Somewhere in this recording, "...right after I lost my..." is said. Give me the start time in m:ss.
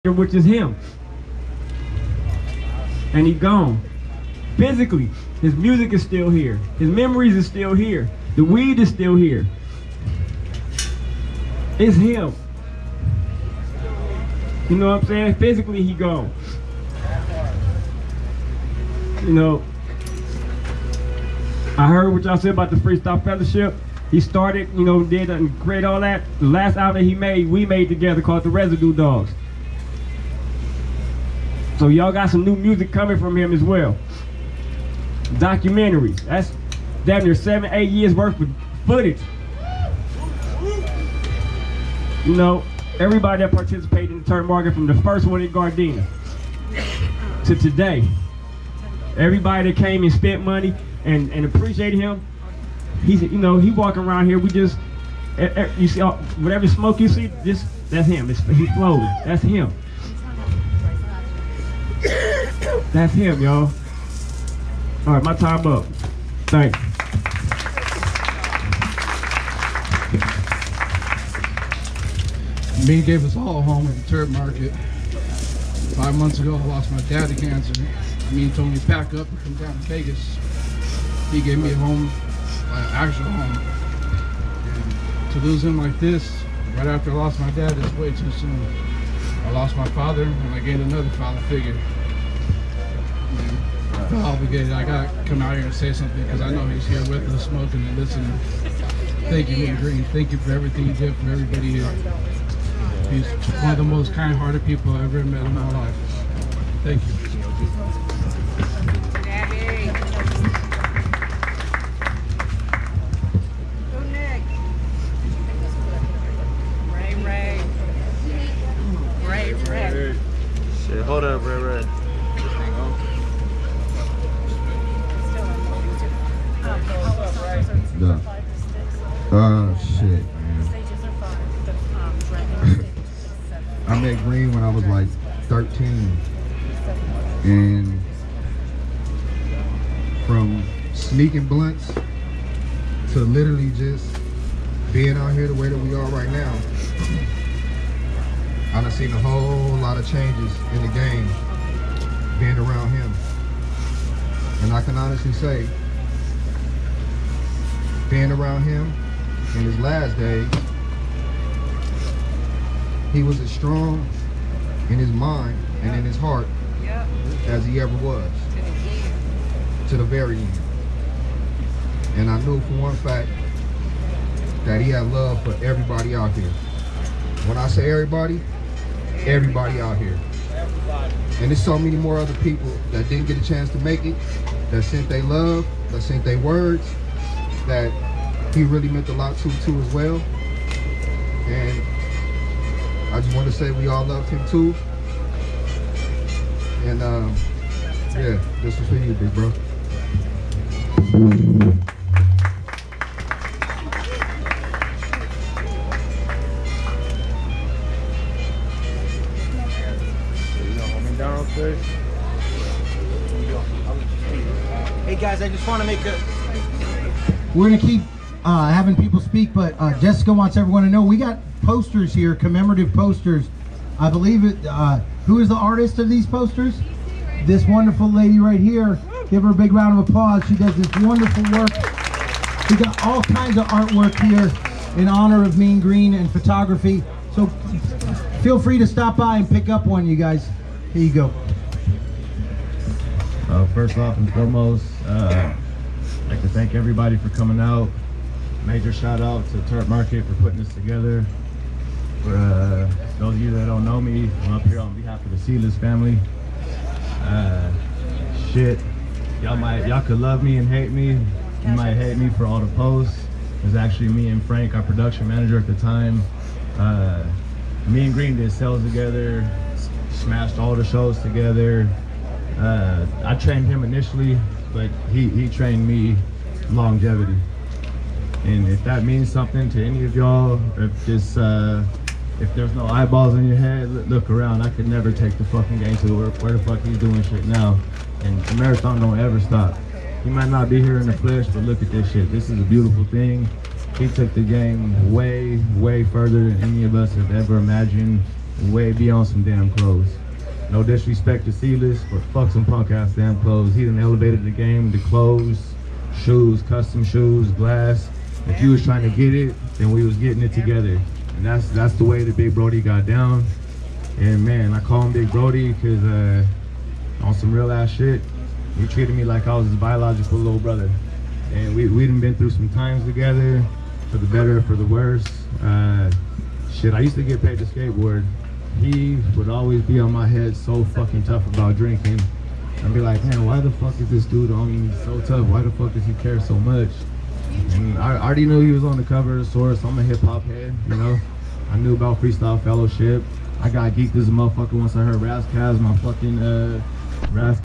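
1:26.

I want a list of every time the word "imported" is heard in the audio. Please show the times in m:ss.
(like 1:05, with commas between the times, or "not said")
not said.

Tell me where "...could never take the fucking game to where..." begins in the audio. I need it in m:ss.
4:44.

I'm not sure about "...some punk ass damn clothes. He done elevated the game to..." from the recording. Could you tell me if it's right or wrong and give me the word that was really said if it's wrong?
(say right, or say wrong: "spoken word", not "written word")
right.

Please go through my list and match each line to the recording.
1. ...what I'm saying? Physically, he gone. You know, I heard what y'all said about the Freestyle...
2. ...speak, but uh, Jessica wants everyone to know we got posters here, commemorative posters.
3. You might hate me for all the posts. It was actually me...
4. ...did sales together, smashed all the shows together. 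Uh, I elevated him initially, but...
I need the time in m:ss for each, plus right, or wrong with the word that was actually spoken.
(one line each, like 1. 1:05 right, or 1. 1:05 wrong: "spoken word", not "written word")
1. 0:14 right
2. 3:39 right
3. 4:21 right
4. 4:28 wrong: "trained", not "elevated".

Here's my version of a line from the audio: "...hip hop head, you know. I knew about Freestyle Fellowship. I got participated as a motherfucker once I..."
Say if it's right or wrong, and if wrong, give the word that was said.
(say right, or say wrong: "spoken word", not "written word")
wrong: "geeked", not "participated".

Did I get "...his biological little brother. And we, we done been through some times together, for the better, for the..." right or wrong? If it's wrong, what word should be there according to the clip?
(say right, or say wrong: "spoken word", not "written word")
right.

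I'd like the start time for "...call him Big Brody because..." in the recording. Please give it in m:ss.
5:14.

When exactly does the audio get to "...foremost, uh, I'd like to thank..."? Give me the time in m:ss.
4:04.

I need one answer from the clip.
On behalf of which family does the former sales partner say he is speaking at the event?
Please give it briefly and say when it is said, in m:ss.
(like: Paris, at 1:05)
Sealess family, at 4:15.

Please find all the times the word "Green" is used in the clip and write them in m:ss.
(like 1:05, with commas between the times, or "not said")
1:39, 2:14, 3:55, 4:28.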